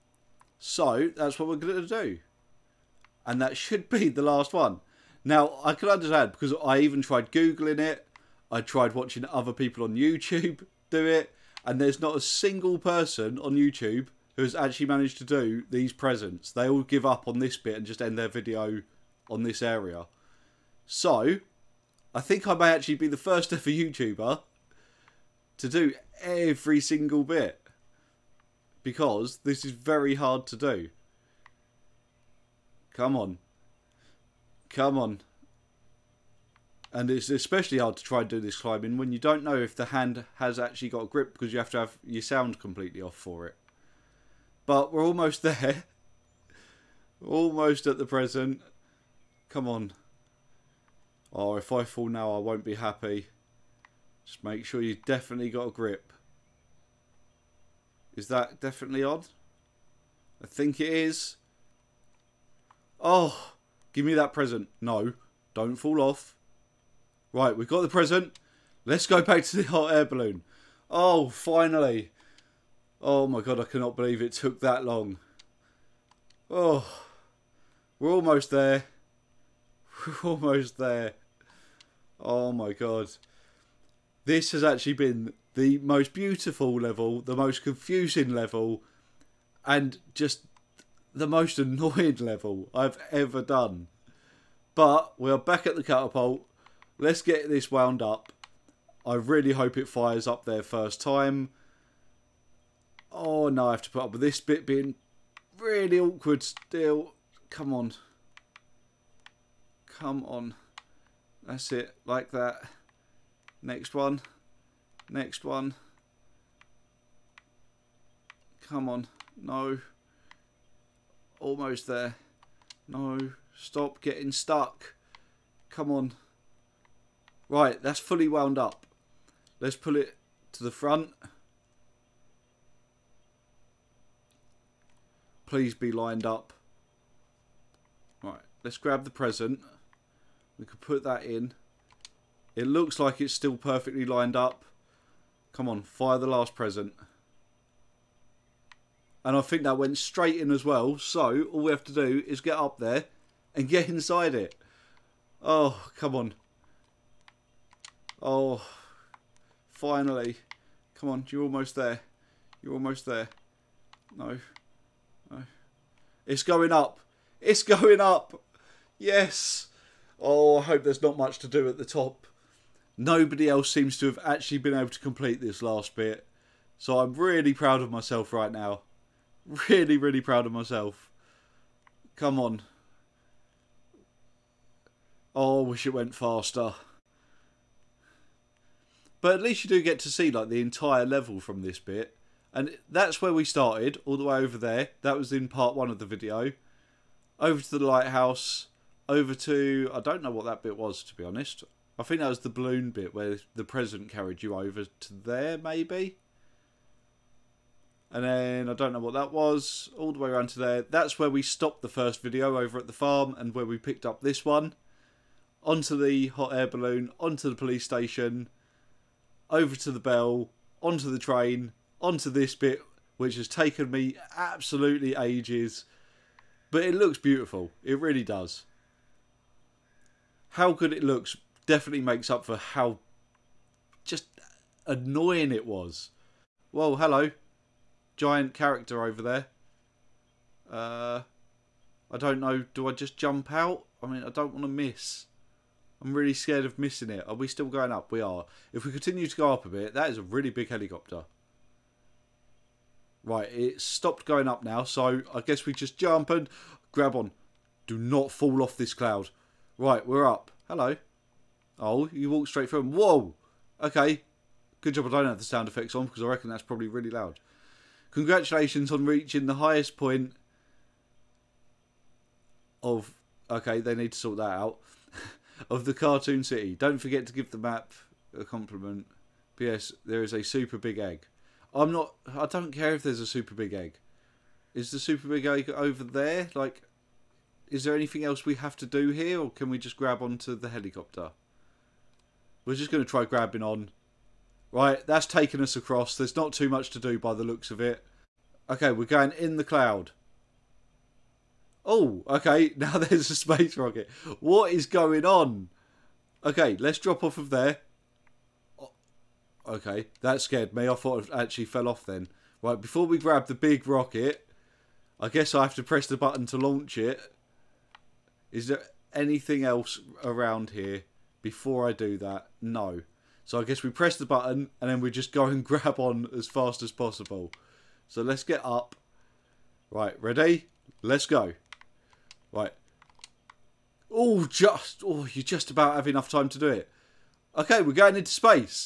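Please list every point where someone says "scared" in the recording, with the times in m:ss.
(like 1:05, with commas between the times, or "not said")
4:06, 5:10.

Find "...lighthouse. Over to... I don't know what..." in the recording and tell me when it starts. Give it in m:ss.
3:17.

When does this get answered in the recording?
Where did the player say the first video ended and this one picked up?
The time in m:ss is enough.
3:32.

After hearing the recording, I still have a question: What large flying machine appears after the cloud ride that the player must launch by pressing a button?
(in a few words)
space rocket.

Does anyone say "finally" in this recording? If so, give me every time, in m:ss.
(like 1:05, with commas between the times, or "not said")
1:11, 2:39.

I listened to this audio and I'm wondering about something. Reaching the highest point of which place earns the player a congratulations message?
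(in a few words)
cartoon city.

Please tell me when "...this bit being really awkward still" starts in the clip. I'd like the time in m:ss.
1:44.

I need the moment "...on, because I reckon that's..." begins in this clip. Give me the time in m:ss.
4:25.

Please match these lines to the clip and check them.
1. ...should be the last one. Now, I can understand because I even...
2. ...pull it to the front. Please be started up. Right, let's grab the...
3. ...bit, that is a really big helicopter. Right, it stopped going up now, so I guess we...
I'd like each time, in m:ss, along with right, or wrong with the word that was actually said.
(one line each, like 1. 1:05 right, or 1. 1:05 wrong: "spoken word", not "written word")
1. 0:03 right
2. 2:09 wrong: "lined", not "started"
3. 4:09 right.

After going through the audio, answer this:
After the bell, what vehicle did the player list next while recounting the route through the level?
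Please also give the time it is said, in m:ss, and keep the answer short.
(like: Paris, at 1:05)
train, at 3:41.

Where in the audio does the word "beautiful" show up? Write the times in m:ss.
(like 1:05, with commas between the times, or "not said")
1:26, 3:47.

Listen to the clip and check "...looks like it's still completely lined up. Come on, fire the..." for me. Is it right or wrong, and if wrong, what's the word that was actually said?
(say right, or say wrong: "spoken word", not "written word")
wrong: "perfectly", not "completely".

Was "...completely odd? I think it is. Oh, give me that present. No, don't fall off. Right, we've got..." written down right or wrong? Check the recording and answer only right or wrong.
wrong.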